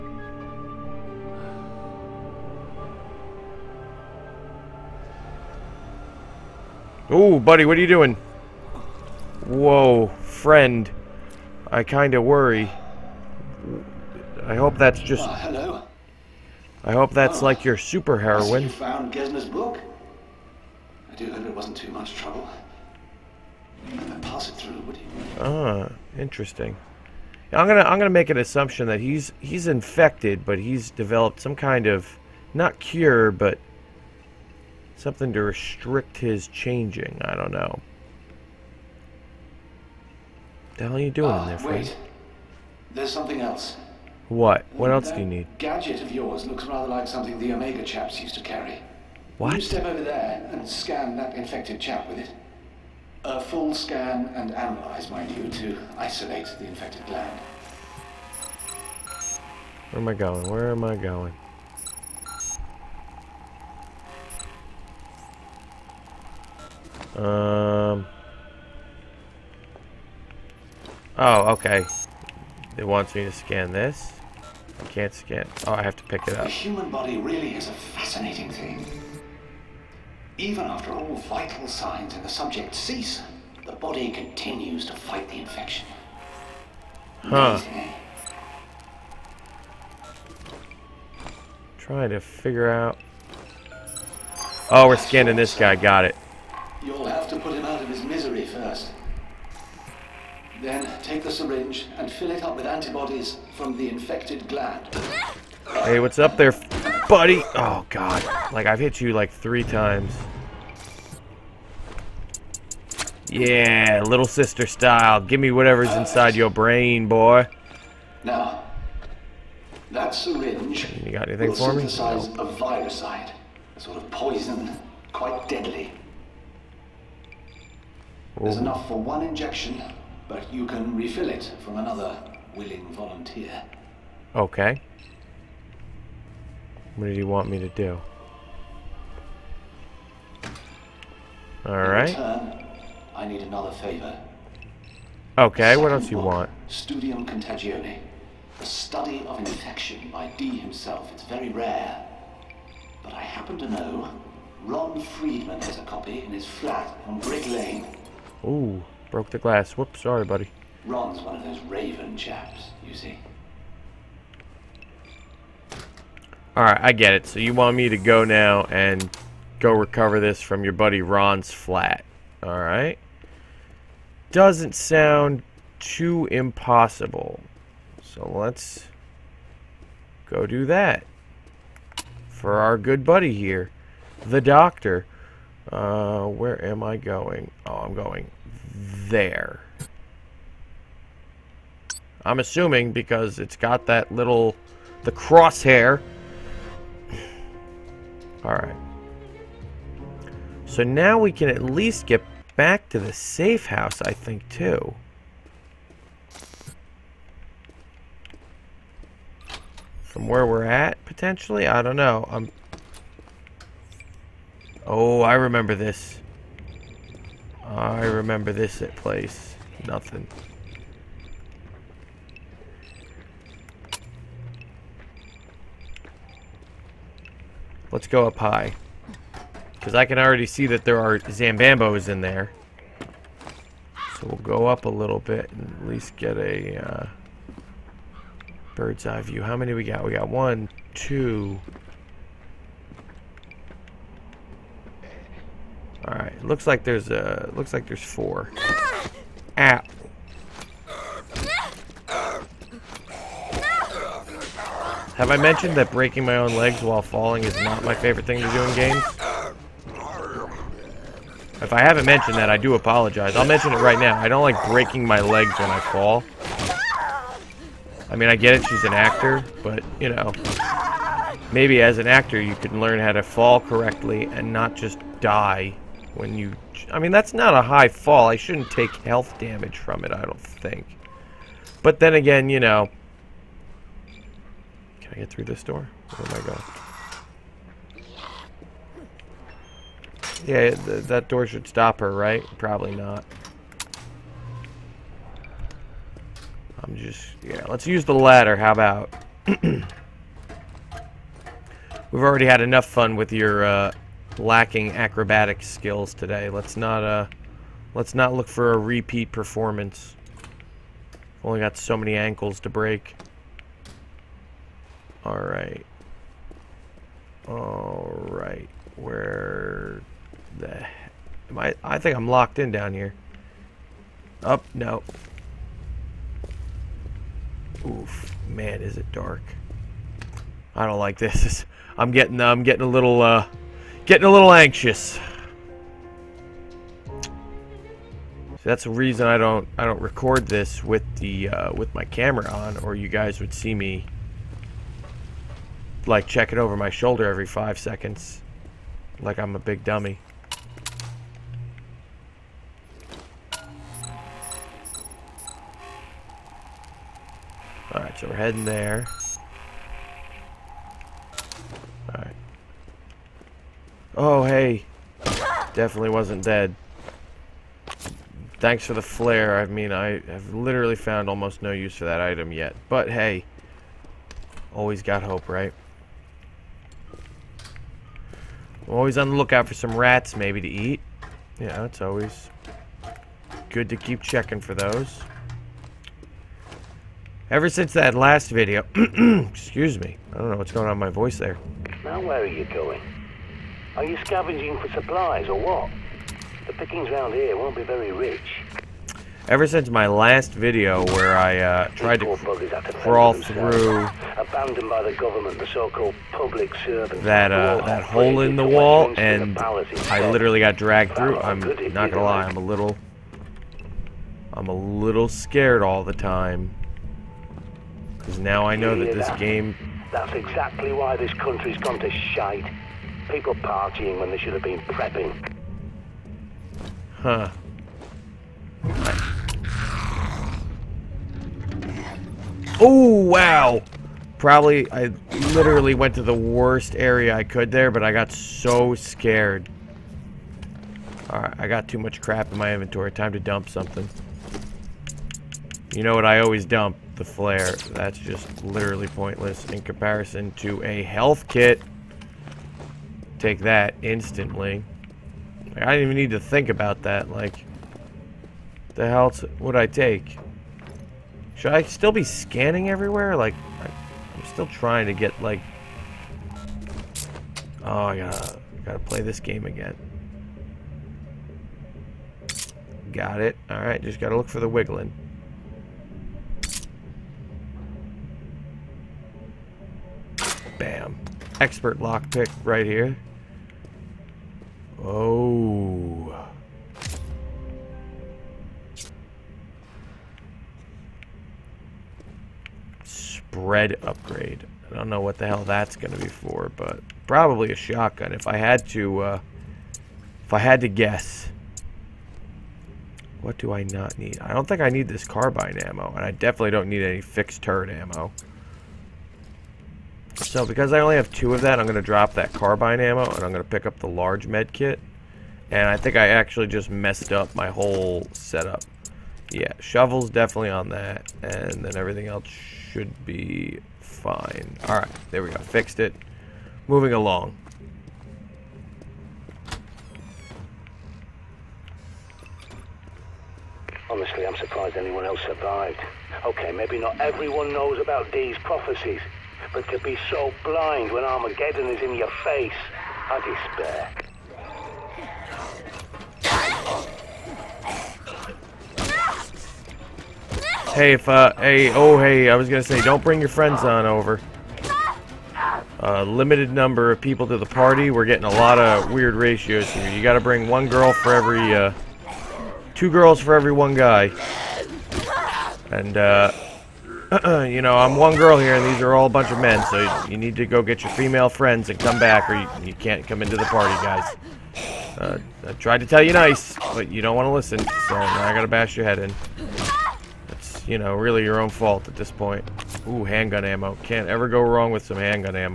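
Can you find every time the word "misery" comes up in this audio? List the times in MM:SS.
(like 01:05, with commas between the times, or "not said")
01:38.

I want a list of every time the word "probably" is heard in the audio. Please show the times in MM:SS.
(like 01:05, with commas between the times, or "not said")
04:52, 07:14, 08:17.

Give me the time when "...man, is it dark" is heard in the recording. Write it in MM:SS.
05:28.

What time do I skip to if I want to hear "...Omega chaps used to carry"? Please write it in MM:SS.
00:47.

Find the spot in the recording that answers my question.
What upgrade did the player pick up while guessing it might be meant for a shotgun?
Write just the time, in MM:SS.
08:13.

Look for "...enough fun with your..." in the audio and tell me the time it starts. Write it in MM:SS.
05:02.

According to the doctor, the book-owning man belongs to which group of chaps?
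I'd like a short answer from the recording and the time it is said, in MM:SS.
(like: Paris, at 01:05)
raven, at 02:41.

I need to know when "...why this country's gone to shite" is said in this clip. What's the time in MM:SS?
07:00.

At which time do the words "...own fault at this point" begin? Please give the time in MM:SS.
09:41.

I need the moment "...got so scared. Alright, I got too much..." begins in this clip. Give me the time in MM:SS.
07:18.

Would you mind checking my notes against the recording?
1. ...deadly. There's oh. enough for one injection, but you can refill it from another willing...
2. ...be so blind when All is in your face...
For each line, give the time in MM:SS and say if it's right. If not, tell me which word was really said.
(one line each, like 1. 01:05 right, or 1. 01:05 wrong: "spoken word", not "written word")
1. 02:05 right
2. 08:59 wrong: "Armageddon", not "All".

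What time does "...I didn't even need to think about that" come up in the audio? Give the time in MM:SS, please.
07:35.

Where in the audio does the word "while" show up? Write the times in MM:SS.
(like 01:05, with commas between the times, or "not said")
04:16.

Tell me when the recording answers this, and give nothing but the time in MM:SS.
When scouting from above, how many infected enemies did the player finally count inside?
04:08.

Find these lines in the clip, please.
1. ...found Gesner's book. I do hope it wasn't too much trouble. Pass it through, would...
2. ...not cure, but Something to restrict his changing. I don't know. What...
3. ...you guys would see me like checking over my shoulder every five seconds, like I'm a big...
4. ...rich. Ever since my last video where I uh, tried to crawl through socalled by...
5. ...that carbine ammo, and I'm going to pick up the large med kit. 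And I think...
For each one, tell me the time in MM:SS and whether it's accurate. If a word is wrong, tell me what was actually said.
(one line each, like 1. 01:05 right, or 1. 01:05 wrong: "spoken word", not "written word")
1. 00:18 right
2. 00:32 right
3. 05:42 right
4. 06:38 wrong: "abandoned", not "socalled"
5. 08:32 right.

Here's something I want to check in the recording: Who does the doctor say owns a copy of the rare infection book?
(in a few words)
Ron Friedman.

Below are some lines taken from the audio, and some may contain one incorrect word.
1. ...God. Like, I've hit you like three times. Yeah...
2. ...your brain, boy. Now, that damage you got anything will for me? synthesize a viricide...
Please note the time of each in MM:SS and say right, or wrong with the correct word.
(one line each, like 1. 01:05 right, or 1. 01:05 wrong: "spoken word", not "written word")
1. 01:47 right
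2. 01:56 wrong: "syringe", not "damage".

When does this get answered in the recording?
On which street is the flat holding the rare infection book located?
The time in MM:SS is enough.
02:37.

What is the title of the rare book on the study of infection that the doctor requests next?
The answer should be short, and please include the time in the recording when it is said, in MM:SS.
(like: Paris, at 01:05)
Studium Contagione, at 02:26.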